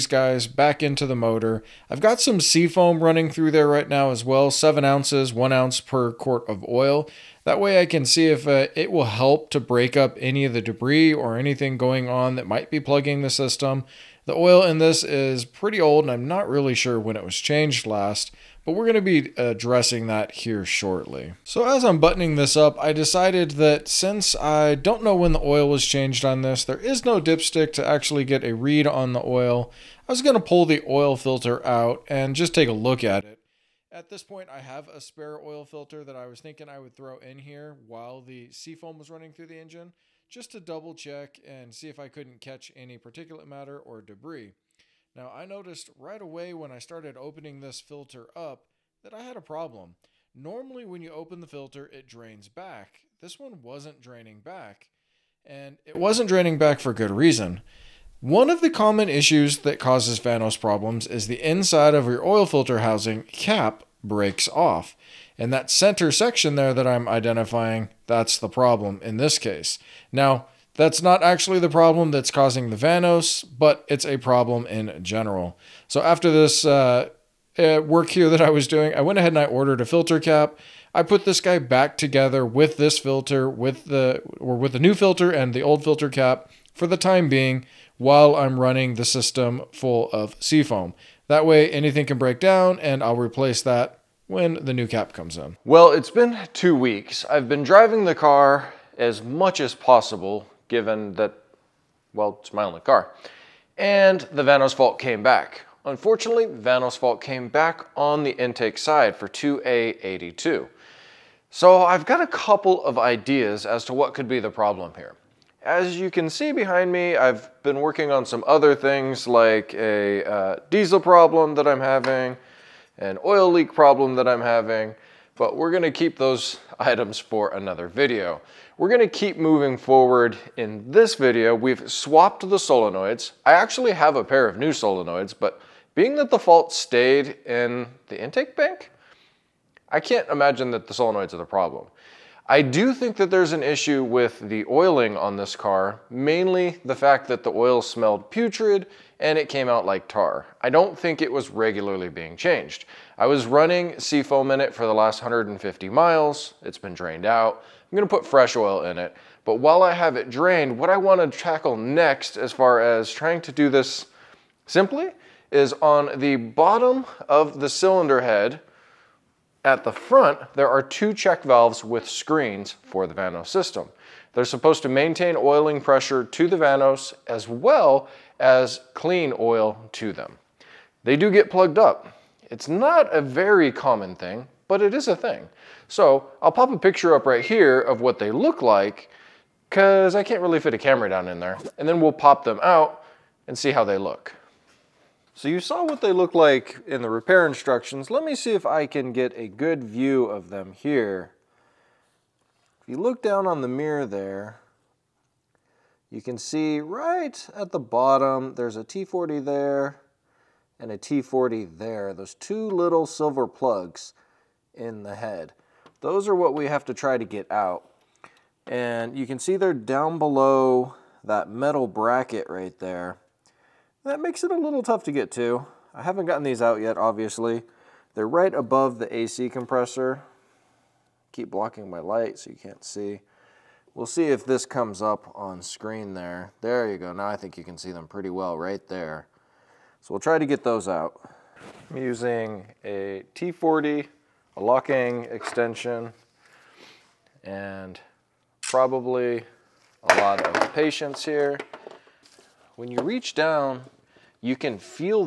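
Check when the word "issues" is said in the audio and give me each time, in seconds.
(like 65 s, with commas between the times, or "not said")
59 s, 143 s.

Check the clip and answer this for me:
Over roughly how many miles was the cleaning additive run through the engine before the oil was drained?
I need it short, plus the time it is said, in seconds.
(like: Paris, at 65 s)
150 miles, at 155 s.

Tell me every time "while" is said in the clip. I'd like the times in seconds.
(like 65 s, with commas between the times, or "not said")
37 s, 87 s, 159 s.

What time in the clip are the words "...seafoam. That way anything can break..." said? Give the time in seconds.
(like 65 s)
90 s.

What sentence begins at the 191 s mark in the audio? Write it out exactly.
And then we'll pop them out and see how they look.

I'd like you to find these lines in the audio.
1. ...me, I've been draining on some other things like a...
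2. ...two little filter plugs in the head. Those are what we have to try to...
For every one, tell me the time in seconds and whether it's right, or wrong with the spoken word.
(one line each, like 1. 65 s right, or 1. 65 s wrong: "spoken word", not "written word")
1. 116 s wrong: "working", not "draining"
2. 212 s wrong: "silver", not "filter".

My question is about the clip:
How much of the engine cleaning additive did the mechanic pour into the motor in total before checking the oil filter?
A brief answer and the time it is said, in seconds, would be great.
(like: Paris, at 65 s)
7 ounces, at 4 s.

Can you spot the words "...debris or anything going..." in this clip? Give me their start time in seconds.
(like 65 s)
10 s.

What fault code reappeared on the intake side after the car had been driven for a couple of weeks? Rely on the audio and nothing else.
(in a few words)
2A82.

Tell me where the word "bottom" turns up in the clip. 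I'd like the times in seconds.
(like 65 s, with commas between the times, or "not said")
166 s, 207 s.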